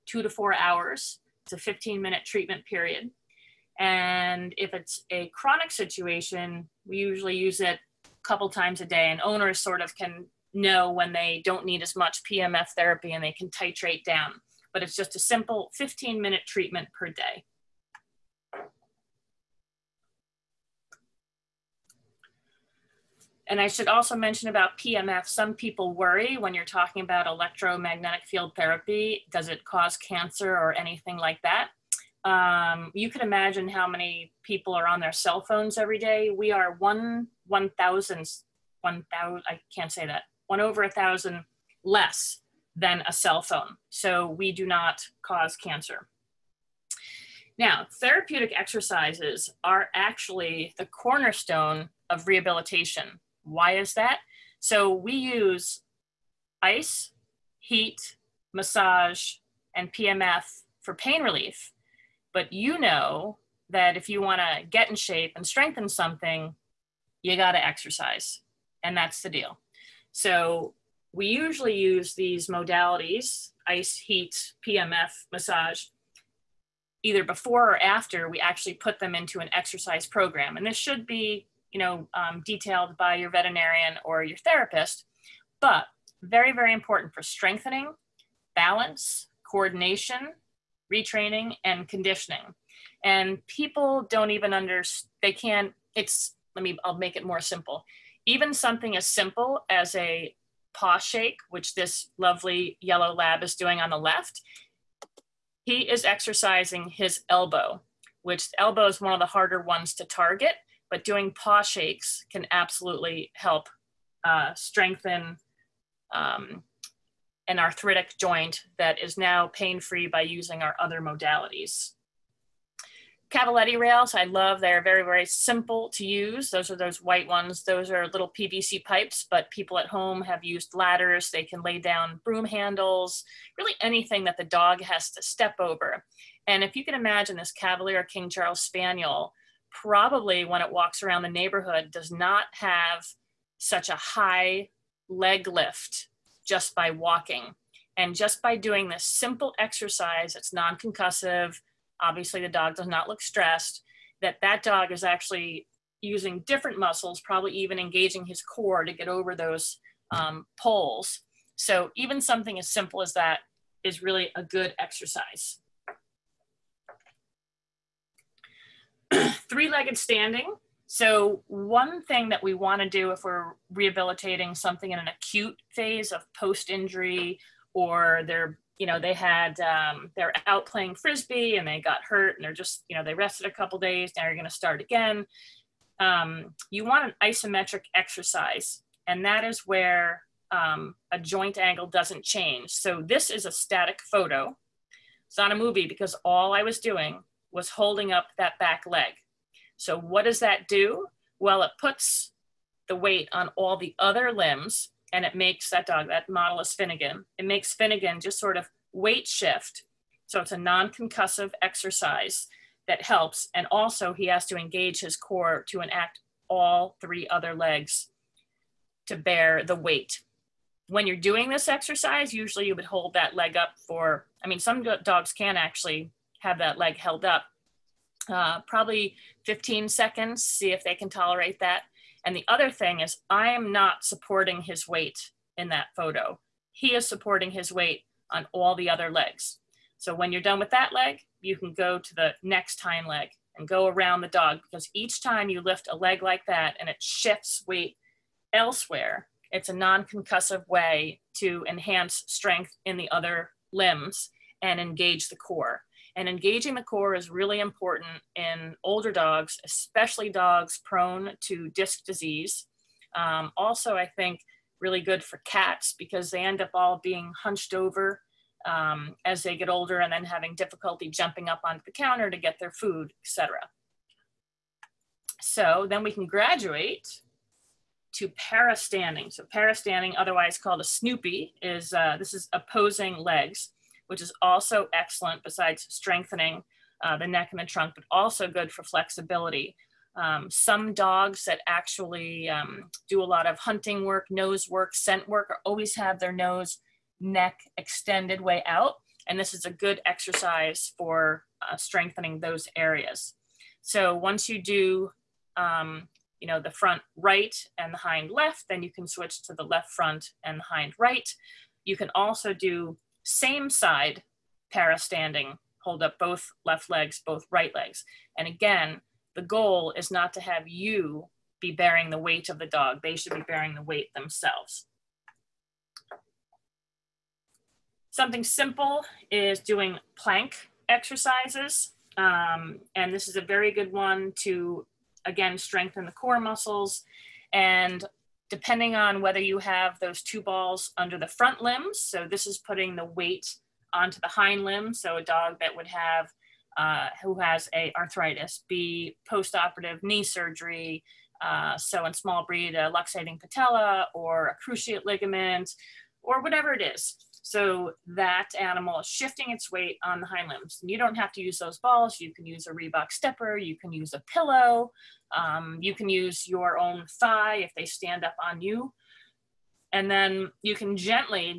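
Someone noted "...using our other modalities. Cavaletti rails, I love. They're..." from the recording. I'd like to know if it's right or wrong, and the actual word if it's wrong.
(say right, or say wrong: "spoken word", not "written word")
right.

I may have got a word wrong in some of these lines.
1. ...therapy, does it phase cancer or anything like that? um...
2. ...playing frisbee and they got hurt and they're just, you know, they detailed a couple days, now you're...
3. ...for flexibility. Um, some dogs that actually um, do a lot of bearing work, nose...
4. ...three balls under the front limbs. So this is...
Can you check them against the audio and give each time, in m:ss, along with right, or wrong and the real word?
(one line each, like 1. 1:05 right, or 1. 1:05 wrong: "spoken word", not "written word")
1. 0:28 wrong: "cause", not "phase"
2. 3:00 wrong: "rested", not "detailed"
3. 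4:48 wrong: "hunting", not "bearing"
4. 5:40 wrong: "two", not "three".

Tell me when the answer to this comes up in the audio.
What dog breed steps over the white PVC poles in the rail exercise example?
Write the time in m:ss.
2:17.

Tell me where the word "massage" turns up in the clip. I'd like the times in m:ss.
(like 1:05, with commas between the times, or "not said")
0:58, 1:15.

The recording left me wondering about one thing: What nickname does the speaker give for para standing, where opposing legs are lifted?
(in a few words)
Snoopy.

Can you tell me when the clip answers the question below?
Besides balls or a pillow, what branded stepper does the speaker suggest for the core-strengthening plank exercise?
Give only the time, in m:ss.
6:02.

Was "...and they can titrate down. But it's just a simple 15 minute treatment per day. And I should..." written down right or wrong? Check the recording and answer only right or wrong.
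right.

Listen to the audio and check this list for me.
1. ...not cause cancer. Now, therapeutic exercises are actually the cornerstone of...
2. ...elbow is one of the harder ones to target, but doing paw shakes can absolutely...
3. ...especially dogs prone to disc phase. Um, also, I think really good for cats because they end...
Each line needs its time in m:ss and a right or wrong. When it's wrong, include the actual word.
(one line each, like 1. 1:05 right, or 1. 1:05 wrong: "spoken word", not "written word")
1. 0:44 right
2. 1:48 right
3. 4:19 wrong: "disease", not "phase".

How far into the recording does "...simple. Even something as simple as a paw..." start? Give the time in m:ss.
1:37.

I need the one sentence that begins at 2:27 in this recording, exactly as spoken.
And just by doing this simple exercise, it's non concussive.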